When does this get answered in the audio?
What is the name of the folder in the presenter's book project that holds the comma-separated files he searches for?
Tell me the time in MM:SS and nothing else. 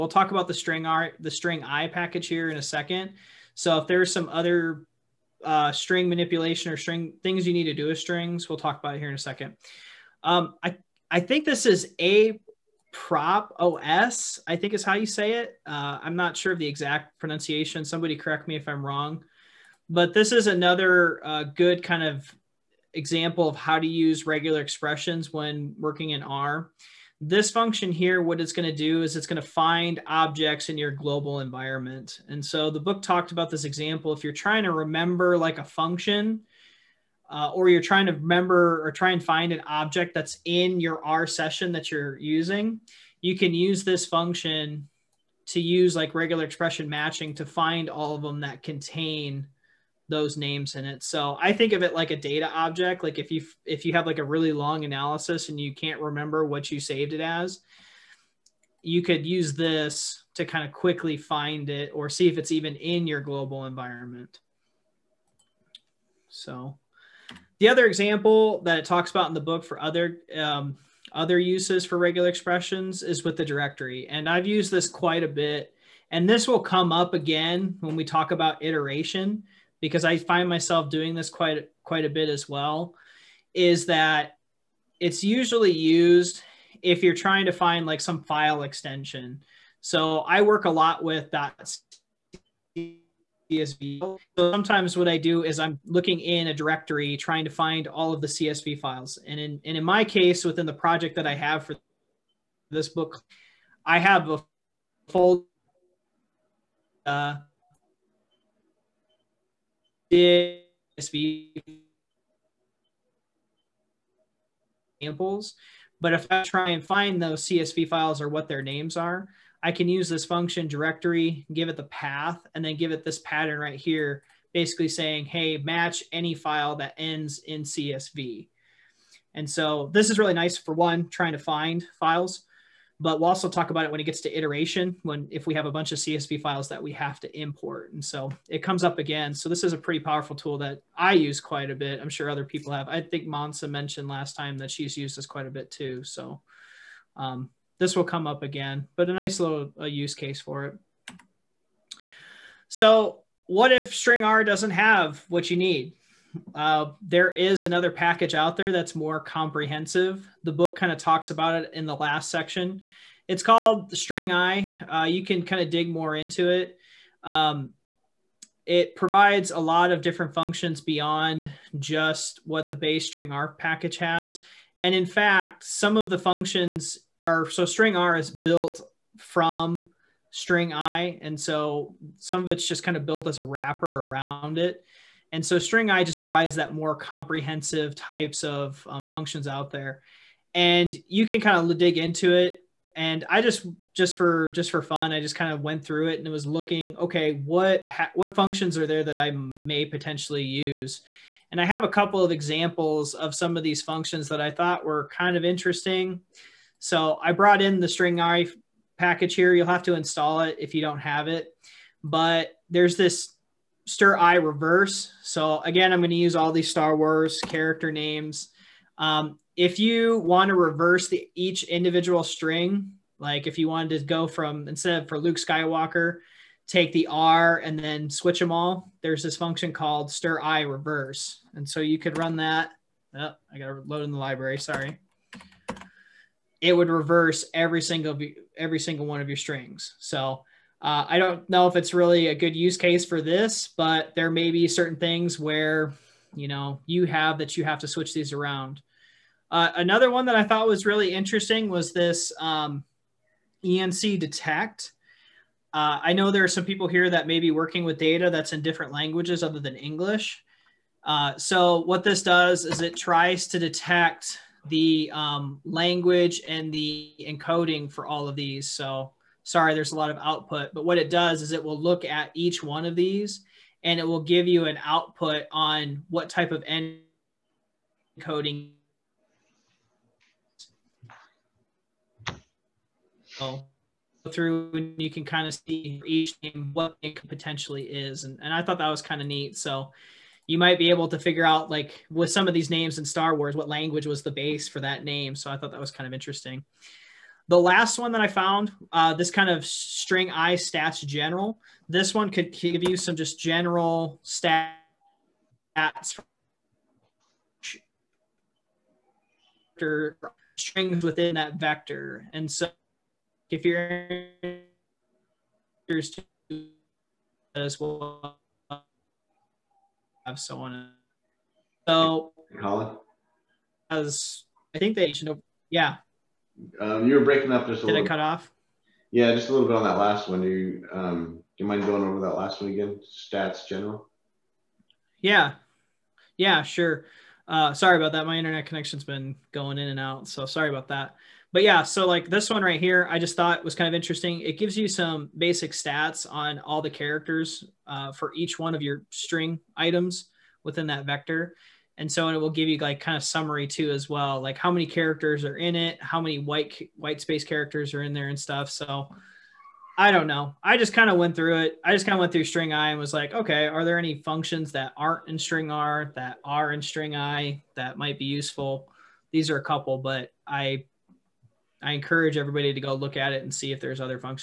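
01:50.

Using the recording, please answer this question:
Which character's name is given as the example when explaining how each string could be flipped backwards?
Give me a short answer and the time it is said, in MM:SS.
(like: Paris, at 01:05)
Luke Skywalker, at 03:45.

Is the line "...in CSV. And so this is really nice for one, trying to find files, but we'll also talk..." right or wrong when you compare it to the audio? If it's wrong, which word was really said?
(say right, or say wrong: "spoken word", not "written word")
right.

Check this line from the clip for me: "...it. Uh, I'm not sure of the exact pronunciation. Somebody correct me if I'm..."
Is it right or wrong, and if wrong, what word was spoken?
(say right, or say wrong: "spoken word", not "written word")
right.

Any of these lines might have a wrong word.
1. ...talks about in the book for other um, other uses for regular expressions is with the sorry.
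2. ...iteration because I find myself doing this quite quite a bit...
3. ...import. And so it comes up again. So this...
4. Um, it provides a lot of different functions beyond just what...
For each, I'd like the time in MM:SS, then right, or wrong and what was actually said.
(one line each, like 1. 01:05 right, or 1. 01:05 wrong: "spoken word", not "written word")
1. 01:08 wrong: "directory", not "sorry"
2. 01:18 right
3. 02:17 right
4. 02:47 right.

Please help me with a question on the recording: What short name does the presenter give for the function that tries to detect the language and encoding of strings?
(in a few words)
ENC detect.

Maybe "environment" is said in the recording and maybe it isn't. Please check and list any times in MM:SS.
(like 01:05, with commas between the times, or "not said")
00:31, 01:03.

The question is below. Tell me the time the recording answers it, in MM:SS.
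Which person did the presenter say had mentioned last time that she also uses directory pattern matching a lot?
02:23.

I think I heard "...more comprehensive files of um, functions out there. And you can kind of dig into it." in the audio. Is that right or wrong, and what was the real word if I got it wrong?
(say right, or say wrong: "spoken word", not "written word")
wrong: "types", not "files".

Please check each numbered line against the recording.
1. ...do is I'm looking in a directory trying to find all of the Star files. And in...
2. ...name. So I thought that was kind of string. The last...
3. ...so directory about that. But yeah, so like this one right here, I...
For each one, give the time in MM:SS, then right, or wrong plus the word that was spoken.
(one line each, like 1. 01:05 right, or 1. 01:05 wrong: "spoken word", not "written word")
1. 01:35 wrong: "CSV", not "Star"
2. 04:55 wrong: "interesting", not "string"
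3. 05:40 wrong: "sorry", not "directory".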